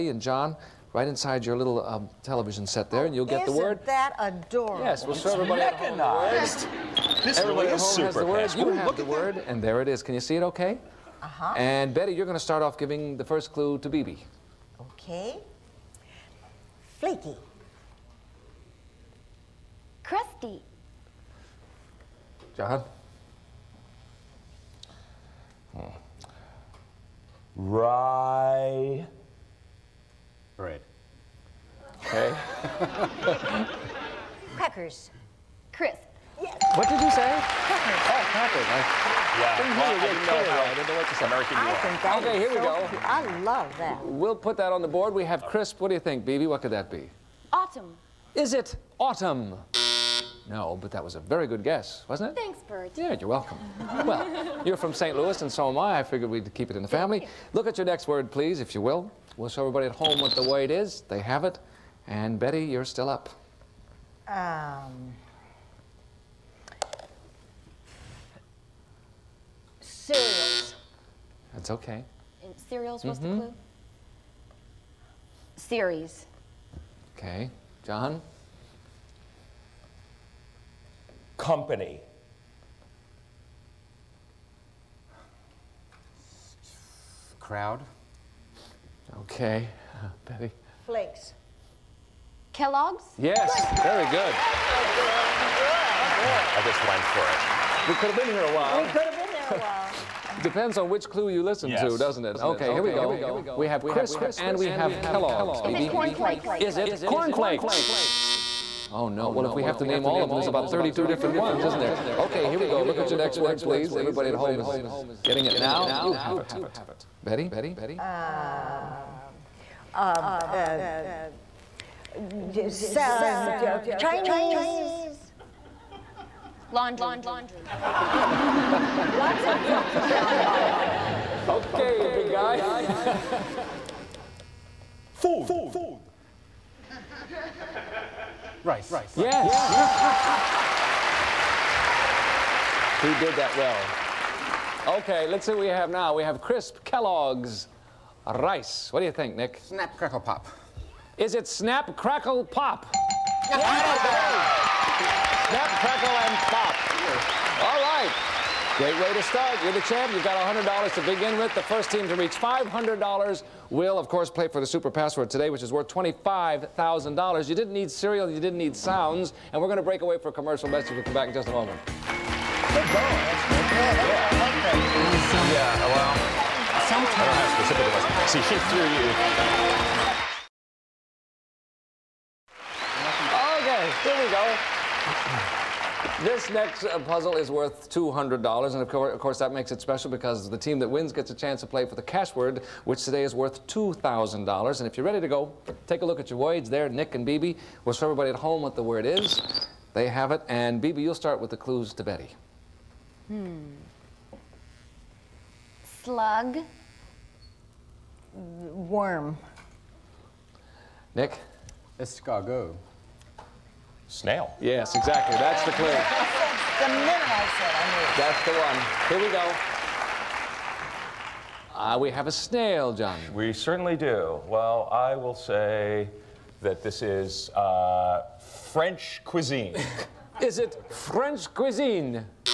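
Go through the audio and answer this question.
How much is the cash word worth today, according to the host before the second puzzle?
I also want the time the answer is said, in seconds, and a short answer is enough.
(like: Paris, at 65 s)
$2,000, at 193 s.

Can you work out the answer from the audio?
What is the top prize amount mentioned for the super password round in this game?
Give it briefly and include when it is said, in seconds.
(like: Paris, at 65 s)
$25,000, at 165 s.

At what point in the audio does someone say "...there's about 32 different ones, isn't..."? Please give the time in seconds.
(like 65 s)
110 s.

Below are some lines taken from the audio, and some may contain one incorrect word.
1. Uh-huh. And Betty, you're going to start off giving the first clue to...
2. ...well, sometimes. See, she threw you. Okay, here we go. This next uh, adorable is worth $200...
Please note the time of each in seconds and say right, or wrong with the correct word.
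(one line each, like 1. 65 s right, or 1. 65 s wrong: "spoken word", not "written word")
1. 11 s right
2. 175 s wrong: "puzzle", not "adorable".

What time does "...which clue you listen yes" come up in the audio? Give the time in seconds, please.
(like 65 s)
100 s.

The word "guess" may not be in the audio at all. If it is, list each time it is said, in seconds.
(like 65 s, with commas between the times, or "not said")
51 s.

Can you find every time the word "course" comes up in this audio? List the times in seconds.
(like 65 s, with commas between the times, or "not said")
164 s, 189 s.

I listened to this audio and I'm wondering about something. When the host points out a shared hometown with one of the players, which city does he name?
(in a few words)
St. Louis.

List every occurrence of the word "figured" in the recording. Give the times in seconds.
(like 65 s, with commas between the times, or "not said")
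56 s.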